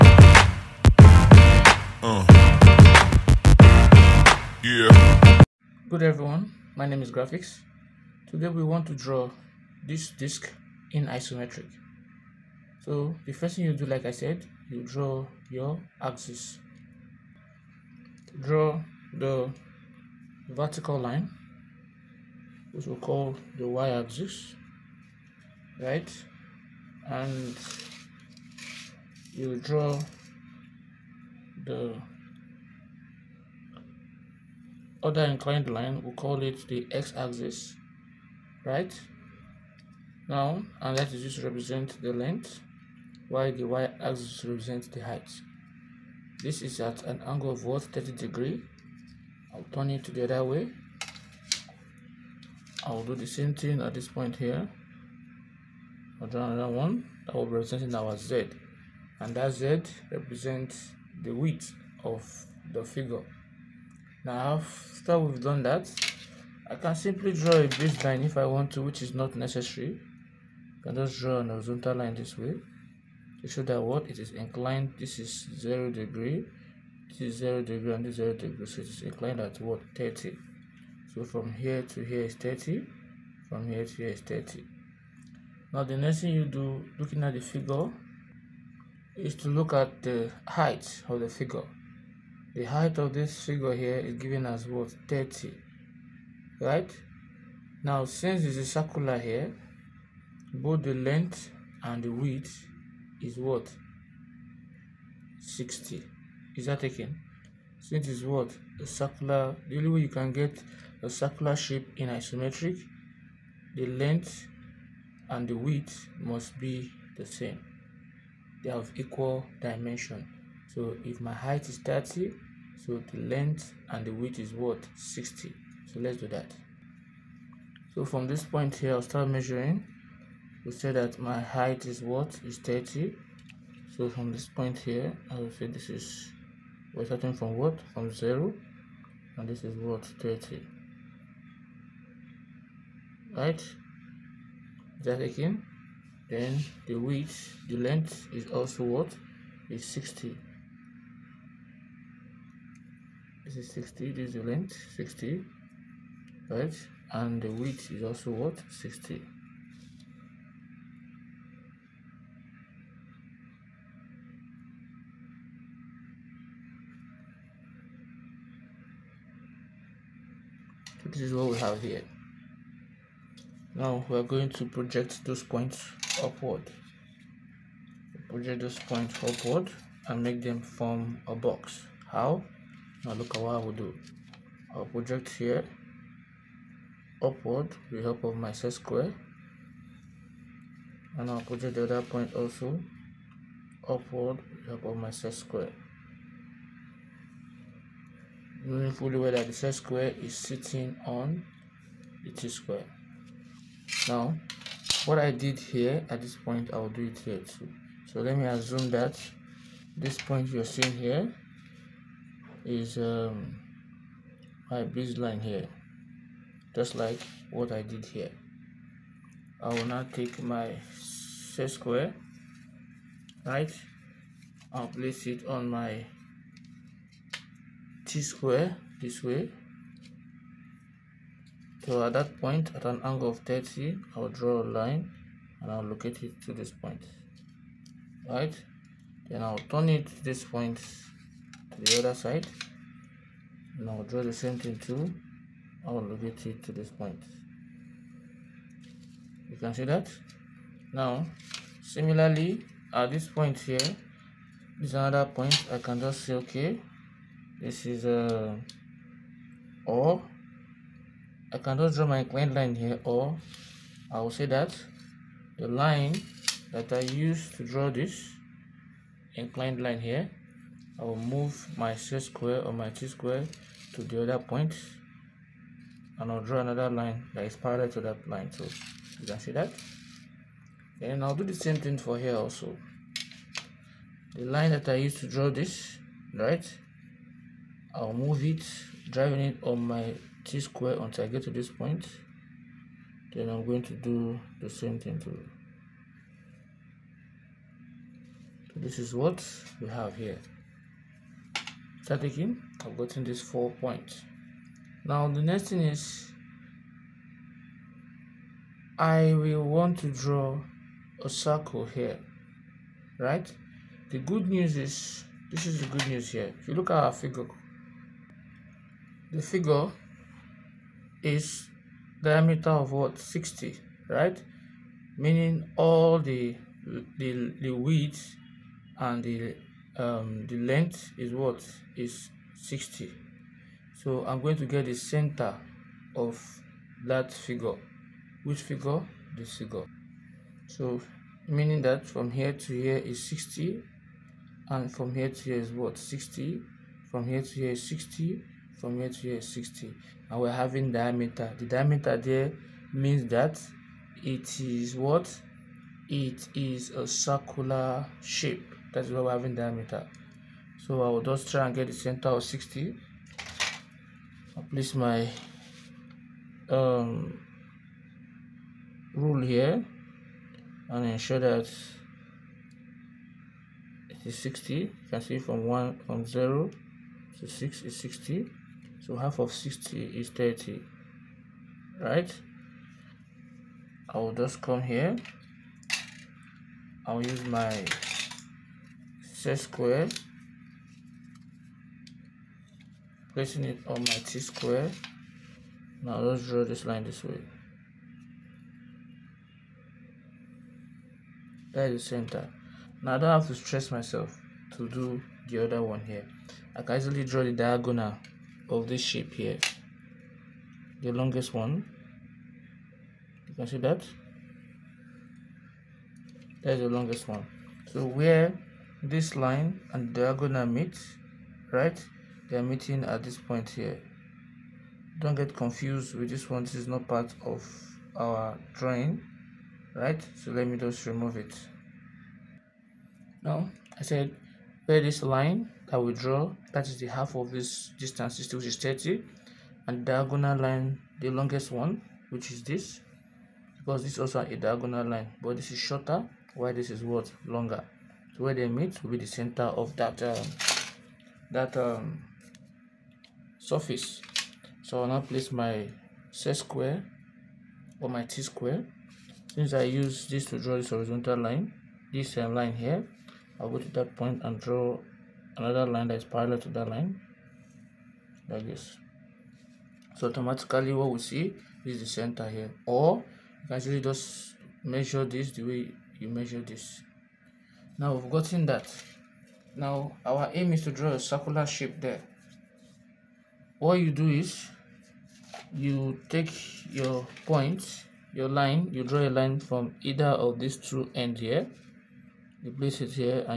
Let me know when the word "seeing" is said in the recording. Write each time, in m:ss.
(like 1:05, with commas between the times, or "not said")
3:30.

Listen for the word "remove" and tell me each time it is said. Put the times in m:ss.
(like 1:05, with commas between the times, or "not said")
7:11.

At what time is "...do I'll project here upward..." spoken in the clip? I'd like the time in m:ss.
3:03.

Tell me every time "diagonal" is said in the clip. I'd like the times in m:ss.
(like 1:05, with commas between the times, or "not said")
6:47, 7:00, 7:20, 7:24.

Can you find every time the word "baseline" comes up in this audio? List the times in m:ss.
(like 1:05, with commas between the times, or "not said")
1:07, 3:34.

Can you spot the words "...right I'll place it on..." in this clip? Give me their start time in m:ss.
3:43.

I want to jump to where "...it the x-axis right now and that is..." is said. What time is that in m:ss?
0:36.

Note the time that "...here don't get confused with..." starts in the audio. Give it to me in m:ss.
7:03.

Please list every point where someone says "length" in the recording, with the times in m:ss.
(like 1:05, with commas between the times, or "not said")
0:42, 1:40, 1:53, 2:03, 2:27, 2:34, 5:30.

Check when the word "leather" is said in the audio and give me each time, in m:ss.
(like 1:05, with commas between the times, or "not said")
not said.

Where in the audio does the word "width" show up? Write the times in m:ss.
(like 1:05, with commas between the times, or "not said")
1:01, 1:42, 1:55, 2:04, 2:26, 2:37, 5:27.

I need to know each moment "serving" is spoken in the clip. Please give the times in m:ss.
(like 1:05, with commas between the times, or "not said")
not said.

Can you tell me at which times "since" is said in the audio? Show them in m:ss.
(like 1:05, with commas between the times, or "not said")
1:38, 1:47, 7:39.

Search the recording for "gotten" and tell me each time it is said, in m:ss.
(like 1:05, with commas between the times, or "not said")
5:02, 7:58.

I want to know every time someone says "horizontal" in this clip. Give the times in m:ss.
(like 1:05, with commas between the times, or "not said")
1:11, 7:40.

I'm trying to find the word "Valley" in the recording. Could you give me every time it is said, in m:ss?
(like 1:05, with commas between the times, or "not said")
not said.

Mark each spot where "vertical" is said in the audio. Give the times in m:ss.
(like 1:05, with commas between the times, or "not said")
0:20.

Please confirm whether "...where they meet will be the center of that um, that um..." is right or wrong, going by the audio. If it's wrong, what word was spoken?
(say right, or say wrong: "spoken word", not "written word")
right.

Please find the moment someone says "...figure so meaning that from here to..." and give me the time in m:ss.
5:39.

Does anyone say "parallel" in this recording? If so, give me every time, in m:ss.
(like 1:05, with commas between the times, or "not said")
4:37, 7:46.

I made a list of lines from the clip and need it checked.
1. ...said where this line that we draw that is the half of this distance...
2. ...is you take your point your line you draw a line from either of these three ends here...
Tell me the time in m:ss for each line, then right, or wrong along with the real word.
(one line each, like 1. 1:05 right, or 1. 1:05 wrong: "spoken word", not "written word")
1. 7:14 right
2. 8:04 wrong: "two", not "three".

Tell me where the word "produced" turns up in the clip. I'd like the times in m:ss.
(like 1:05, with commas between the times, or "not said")
not said.